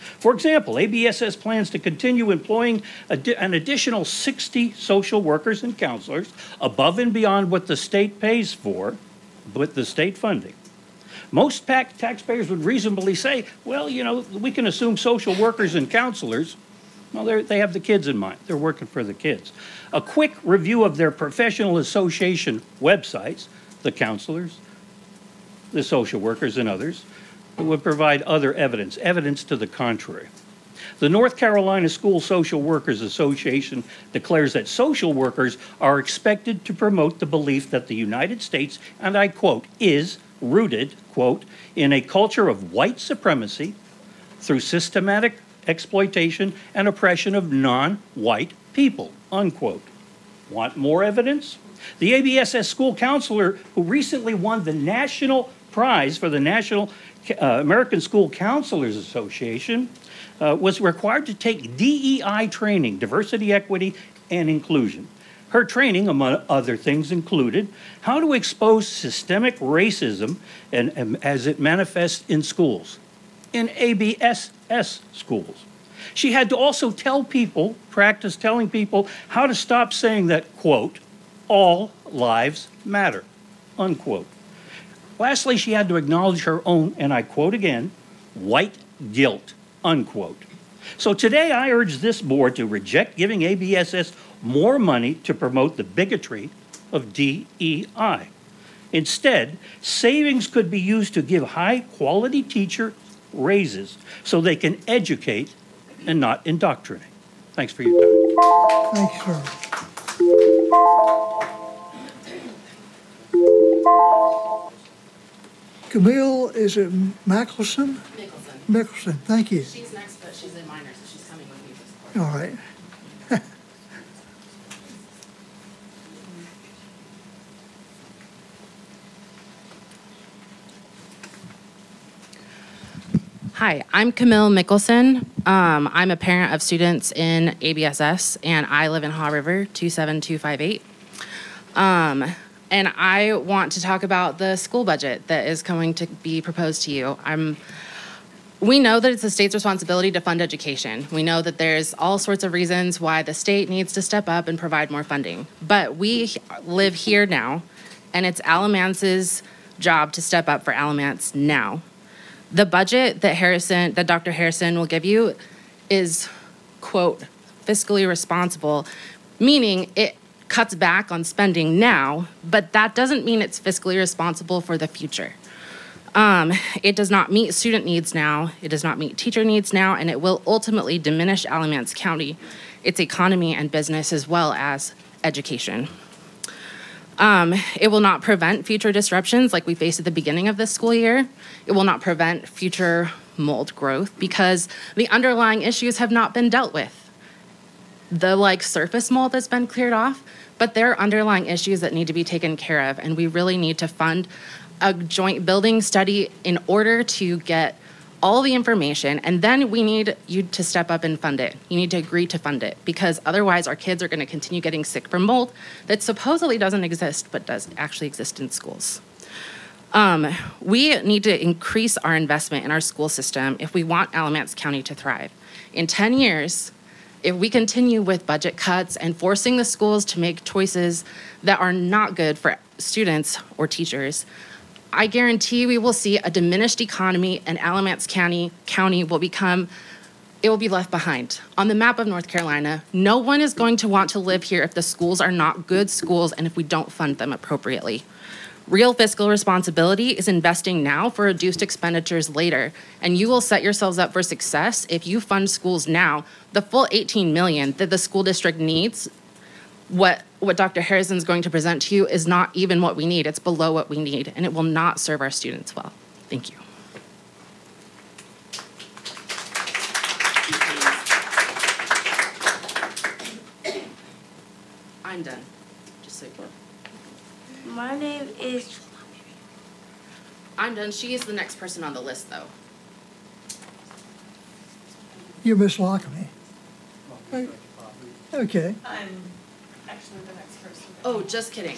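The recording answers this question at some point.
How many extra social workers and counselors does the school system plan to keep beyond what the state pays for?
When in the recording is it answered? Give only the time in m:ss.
0:04.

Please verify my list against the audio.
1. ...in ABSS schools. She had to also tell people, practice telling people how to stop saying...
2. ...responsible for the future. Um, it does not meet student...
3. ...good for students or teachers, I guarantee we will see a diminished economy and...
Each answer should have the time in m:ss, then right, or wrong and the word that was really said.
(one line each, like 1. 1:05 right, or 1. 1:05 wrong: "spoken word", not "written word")
1. 1:13 right
2. 2:53 right
3. 3:52 right.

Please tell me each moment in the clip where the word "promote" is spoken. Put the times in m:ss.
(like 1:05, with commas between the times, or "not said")
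0:36, 1:35.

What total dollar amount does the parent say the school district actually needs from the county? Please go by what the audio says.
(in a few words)
18 million.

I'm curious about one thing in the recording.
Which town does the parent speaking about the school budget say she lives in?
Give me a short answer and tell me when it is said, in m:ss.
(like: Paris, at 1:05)
Haw River, at 2:19.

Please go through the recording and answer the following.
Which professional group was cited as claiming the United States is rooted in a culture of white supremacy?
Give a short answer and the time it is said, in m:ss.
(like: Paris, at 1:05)
North Carolina School Social Workers Association, at 0:31.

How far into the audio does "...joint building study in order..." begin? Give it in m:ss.
3:24.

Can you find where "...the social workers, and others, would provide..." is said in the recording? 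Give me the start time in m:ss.
0:25.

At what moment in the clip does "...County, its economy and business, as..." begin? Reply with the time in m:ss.
3:01.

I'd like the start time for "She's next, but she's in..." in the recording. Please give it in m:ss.
1:59.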